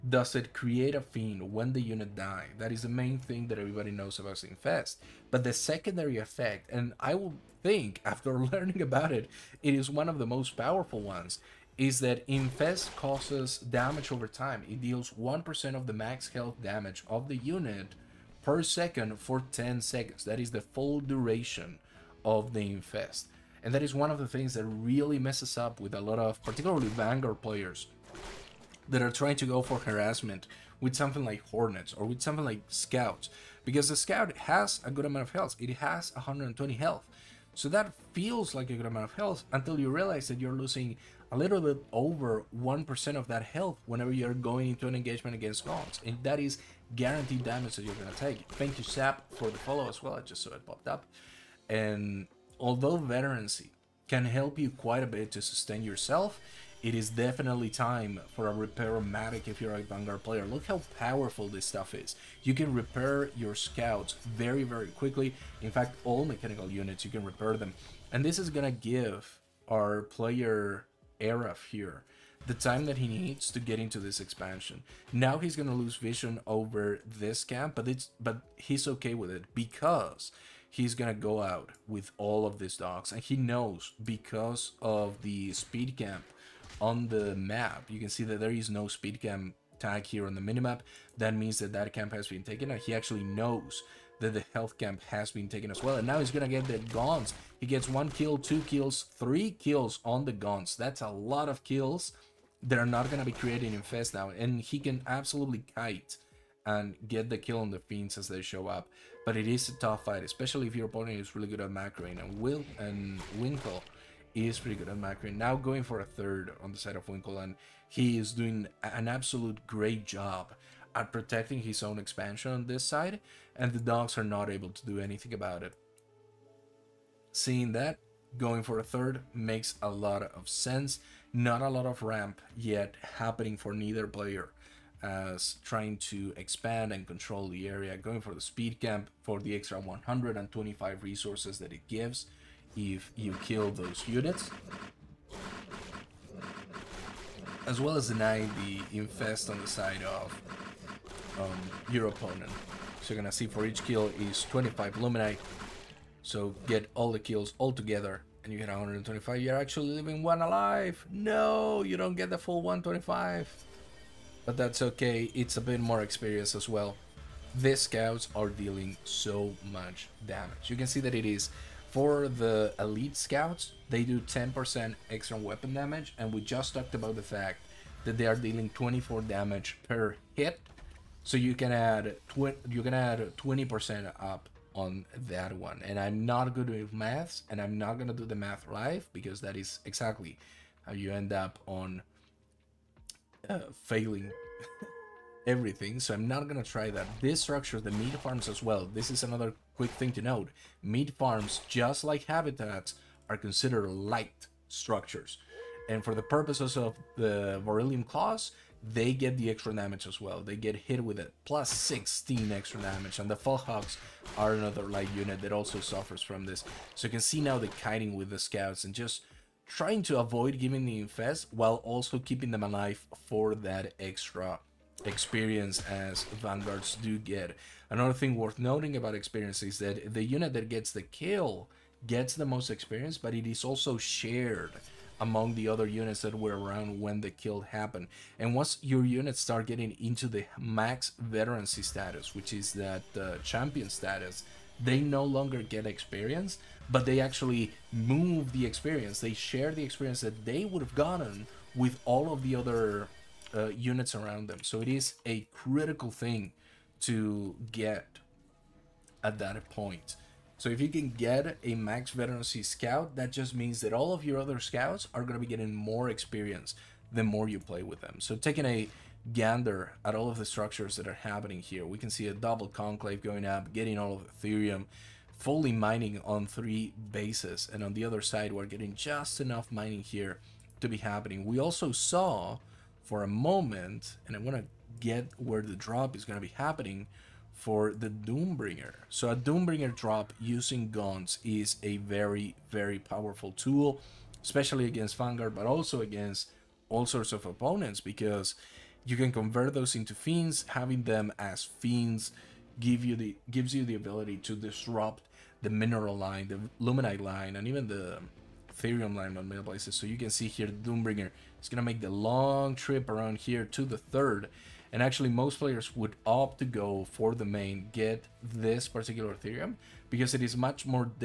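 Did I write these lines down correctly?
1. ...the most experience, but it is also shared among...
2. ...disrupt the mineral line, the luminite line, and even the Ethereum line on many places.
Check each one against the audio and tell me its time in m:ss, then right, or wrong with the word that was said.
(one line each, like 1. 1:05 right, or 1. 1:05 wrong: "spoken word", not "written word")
1. 3:52 right
2. 5:04 right.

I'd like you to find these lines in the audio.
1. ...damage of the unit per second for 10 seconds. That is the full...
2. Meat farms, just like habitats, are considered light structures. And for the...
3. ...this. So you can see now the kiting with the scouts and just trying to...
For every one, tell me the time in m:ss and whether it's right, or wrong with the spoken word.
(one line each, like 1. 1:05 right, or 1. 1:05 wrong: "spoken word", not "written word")
1. 0:16 right
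2. 3:20 right
3. 3:36 right.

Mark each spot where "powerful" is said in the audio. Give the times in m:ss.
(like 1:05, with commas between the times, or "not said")
0:10, 1:00, 4:52.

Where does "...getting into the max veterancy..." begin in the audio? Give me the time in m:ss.
3:59.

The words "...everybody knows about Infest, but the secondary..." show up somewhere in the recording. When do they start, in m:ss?
0:03.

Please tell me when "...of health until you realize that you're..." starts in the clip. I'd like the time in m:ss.
0:39.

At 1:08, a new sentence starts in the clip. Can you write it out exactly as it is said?
And this is gonna give our player here, the time that he needs to get into this expansion.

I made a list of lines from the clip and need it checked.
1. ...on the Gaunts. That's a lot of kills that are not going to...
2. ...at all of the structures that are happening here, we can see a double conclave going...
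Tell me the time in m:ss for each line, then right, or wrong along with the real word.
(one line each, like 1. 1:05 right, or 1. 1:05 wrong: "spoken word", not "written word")
1. 1:40 right
2. 4:30 right.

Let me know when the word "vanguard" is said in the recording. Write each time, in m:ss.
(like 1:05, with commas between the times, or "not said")
0:26, 0:59, 3:46, 4:55.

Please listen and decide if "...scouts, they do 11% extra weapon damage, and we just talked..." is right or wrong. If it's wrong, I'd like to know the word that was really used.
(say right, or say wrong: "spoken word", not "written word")
wrong: "10", not "11".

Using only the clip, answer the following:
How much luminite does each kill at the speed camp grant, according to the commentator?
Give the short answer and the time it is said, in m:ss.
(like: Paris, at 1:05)
25, at 2:34.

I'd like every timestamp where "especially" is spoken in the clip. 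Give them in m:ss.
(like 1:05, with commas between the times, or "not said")
1:50, 4:54.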